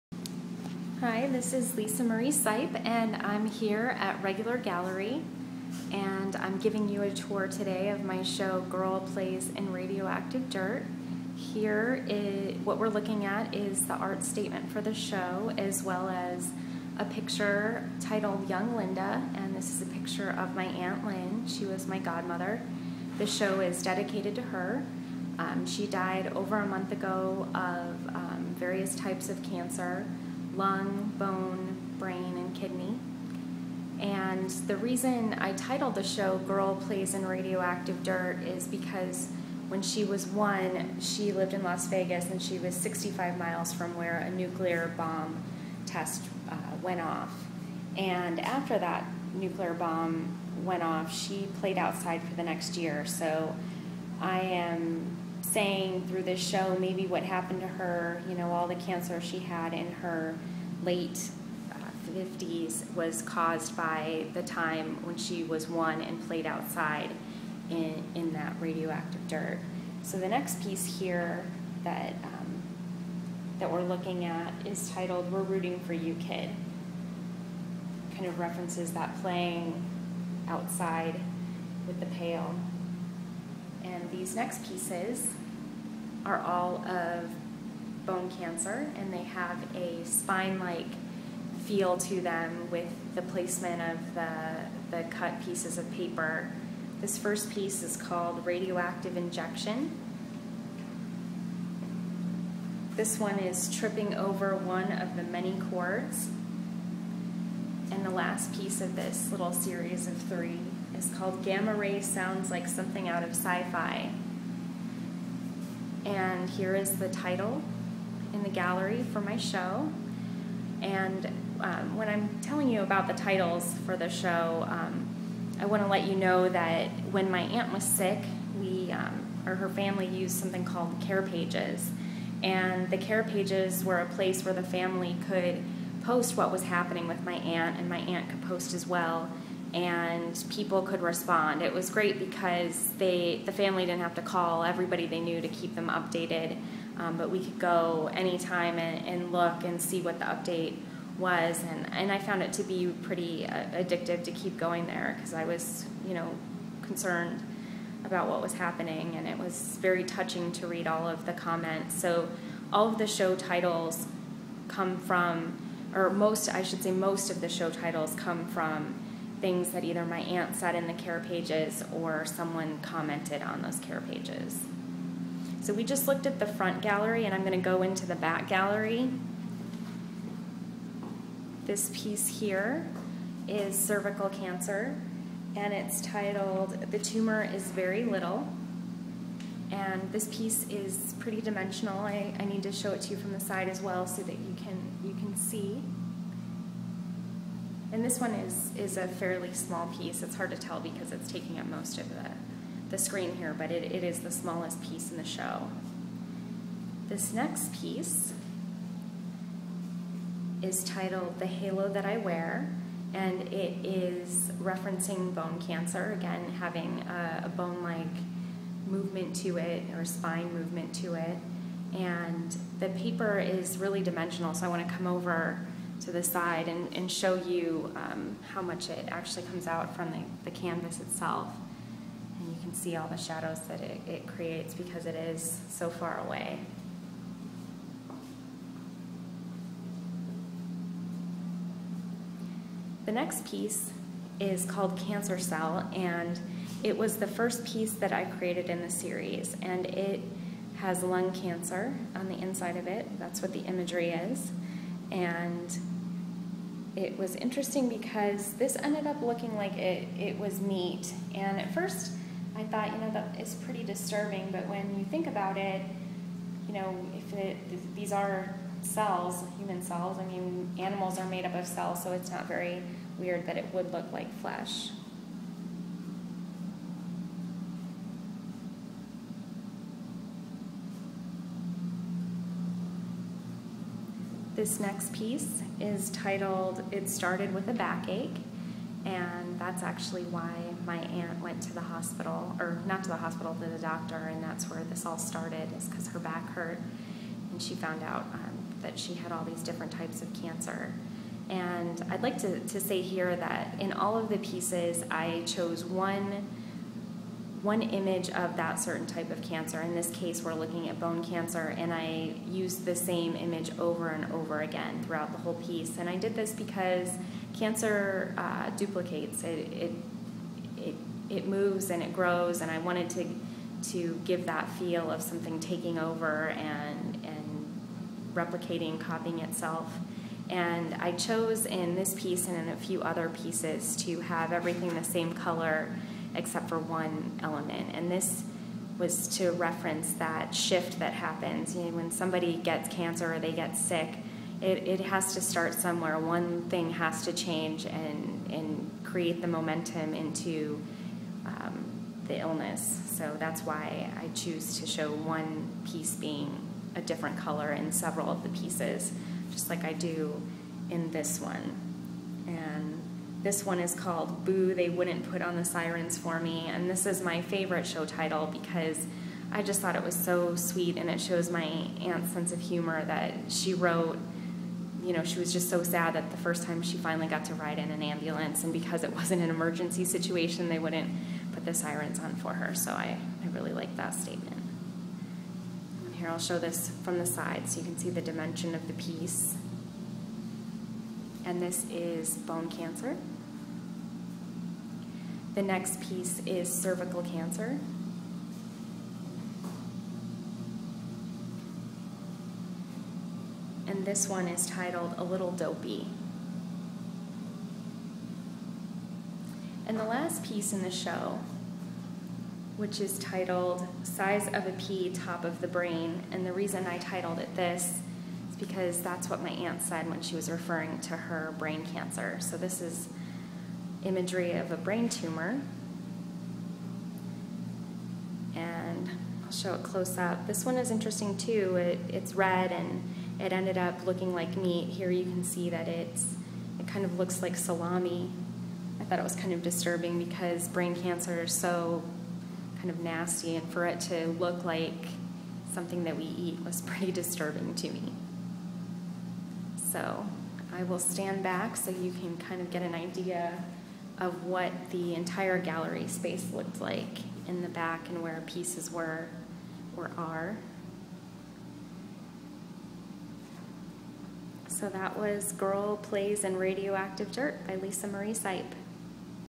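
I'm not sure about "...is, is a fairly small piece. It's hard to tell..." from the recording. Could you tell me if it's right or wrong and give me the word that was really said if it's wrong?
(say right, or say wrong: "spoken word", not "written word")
right.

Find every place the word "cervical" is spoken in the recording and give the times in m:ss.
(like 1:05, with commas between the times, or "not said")
3:03, 6:36.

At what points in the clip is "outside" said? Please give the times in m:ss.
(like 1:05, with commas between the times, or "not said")
0:51, 1:06, 1:20.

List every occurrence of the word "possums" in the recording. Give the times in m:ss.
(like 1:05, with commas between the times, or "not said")
not said.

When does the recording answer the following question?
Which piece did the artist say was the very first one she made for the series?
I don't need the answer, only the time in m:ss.
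4:04.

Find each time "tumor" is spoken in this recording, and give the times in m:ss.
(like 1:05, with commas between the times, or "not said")
3:06, 7:05.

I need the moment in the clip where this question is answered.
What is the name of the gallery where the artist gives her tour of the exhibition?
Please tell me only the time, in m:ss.
0:04.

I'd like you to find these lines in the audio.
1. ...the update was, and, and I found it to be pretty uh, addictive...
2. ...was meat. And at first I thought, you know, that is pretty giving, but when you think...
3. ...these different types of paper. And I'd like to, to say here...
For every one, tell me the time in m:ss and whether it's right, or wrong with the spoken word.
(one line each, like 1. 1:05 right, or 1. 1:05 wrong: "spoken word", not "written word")
1. 2:30 right
2. 4:20 wrong: "disturbing", not "giving"
3. 4:59 wrong: "cancer", not "paper".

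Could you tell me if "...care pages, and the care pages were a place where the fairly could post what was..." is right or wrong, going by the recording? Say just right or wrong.
wrong.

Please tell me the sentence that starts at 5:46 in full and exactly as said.
One thing has to change and, and create the momentum into um, the illness.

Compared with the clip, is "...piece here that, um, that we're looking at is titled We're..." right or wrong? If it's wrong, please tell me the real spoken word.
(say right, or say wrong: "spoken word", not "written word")
right.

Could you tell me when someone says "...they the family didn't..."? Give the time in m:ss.
2:22.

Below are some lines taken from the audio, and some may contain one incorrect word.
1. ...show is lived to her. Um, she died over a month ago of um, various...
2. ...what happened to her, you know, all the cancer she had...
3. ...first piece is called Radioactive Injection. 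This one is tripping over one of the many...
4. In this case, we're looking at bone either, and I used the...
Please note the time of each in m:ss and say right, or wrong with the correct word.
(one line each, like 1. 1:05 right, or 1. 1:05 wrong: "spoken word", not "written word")
1. 0:23 wrong: "dedicated", not "lived"
2. 0:57 right
3. 1:37 right
4. 5:09 wrong: "cancer", not "either".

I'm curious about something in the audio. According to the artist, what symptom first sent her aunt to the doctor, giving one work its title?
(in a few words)
A backache.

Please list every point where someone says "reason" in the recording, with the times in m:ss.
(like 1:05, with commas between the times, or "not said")
0:34, 6:56.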